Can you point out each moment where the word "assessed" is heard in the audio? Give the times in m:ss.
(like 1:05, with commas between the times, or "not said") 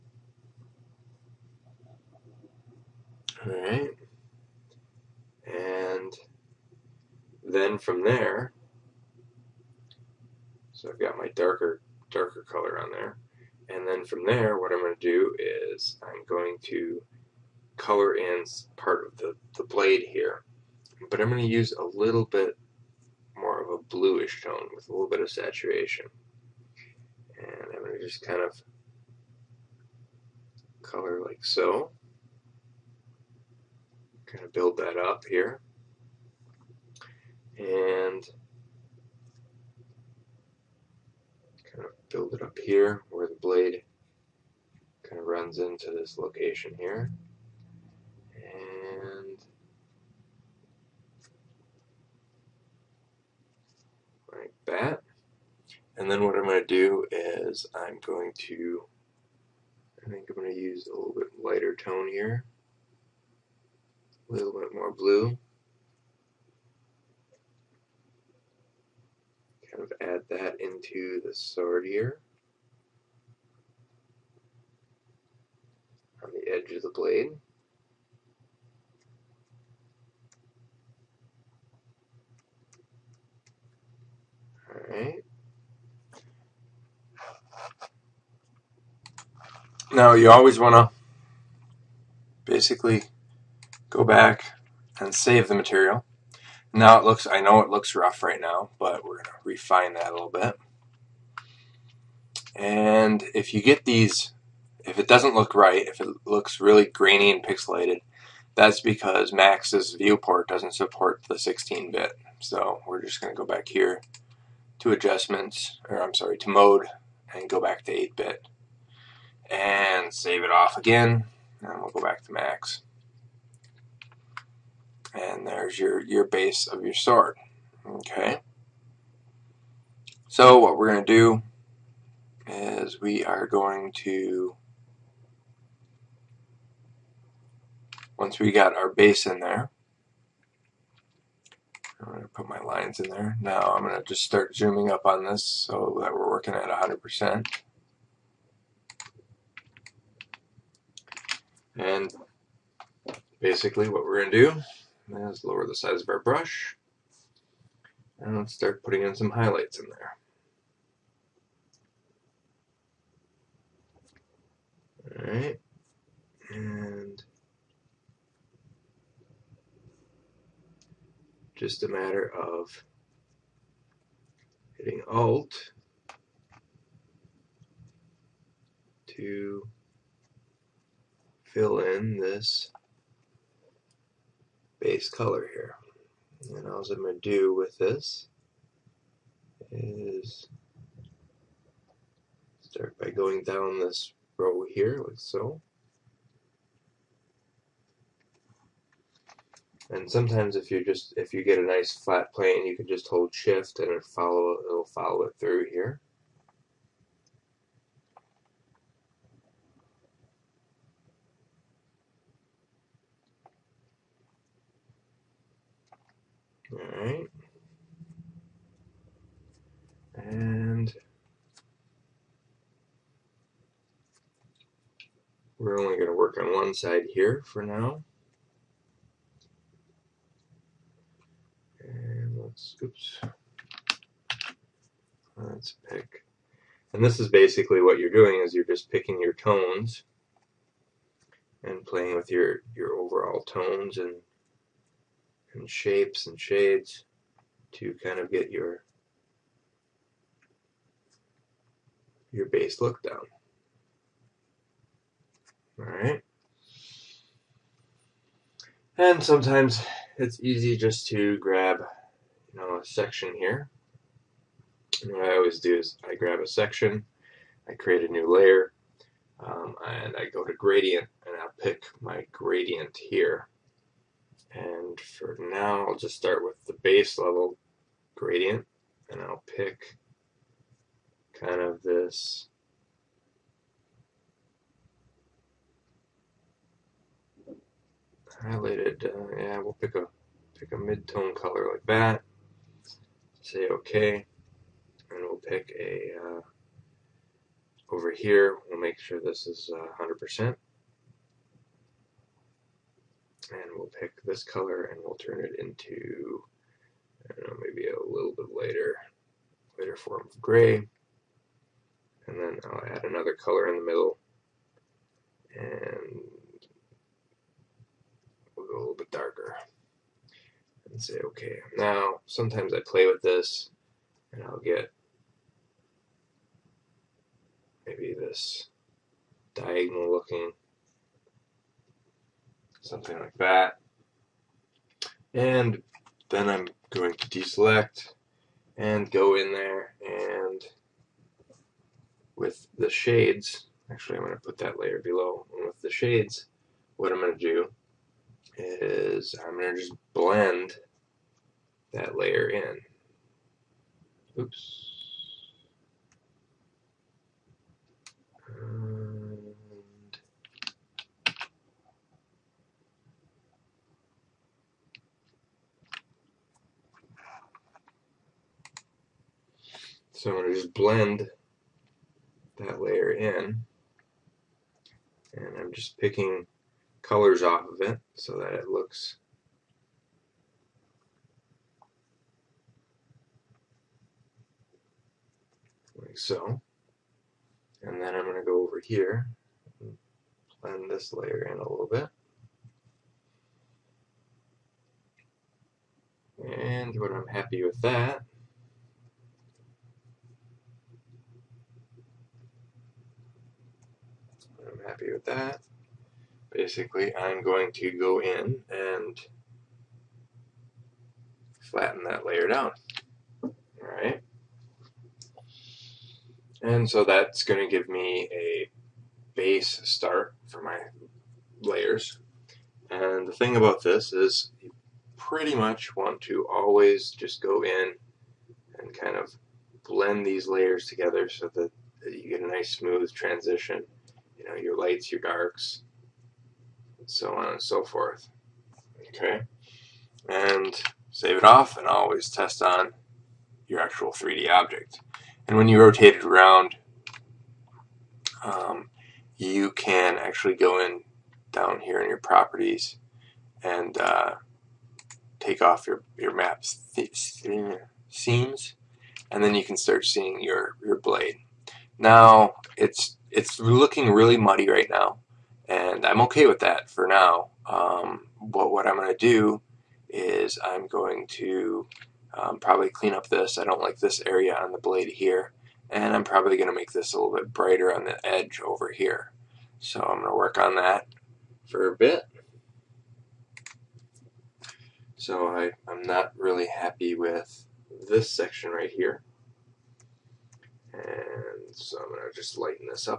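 not said.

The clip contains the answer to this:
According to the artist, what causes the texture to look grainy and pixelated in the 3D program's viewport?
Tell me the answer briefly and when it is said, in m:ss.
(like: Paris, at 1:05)
Doesn't support 16-bit, at 1:51.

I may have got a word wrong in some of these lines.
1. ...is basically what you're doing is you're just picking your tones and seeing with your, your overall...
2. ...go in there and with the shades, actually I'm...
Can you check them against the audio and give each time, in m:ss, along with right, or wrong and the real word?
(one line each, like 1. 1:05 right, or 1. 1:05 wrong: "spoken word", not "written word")
1. 3:57 wrong: "playing", not "seeing"
2. 5:39 right.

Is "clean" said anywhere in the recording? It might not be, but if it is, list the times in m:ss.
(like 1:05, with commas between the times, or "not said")
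7:52.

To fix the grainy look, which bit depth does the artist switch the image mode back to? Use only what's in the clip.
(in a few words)
8-bit.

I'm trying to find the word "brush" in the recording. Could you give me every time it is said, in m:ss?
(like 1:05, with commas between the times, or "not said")
2:36.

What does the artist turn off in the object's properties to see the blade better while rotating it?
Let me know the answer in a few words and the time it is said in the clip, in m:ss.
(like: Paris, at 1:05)
Map seams, at 7:36.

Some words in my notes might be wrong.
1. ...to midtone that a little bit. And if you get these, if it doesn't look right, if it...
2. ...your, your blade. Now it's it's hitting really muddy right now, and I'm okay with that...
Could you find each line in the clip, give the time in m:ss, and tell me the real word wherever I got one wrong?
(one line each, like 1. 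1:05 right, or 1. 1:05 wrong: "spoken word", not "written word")
1. 1:39 wrong: "refine", not "midtone"
2. 7:40 wrong: "looking", not "hitting".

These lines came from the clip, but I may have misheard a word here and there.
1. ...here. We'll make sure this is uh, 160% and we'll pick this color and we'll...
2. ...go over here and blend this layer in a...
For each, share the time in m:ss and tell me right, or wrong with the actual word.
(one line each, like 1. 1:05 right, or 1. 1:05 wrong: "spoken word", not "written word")
1. 4:58 wrong: "100", not "160"
2. 6:28 right.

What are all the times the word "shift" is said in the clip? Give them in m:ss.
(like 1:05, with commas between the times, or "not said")
3:23.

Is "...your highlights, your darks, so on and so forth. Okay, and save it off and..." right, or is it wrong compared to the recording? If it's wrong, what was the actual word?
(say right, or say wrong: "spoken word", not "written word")
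wrong: "lights", not "highlights".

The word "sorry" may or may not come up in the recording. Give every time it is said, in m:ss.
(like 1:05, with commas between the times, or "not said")
1:56.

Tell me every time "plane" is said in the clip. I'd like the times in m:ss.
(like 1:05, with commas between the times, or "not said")
3:22.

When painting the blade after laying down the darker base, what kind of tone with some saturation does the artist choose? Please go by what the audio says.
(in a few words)
Bluish tone.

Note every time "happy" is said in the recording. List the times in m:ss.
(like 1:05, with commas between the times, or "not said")
6:37, 6:44, 8:06.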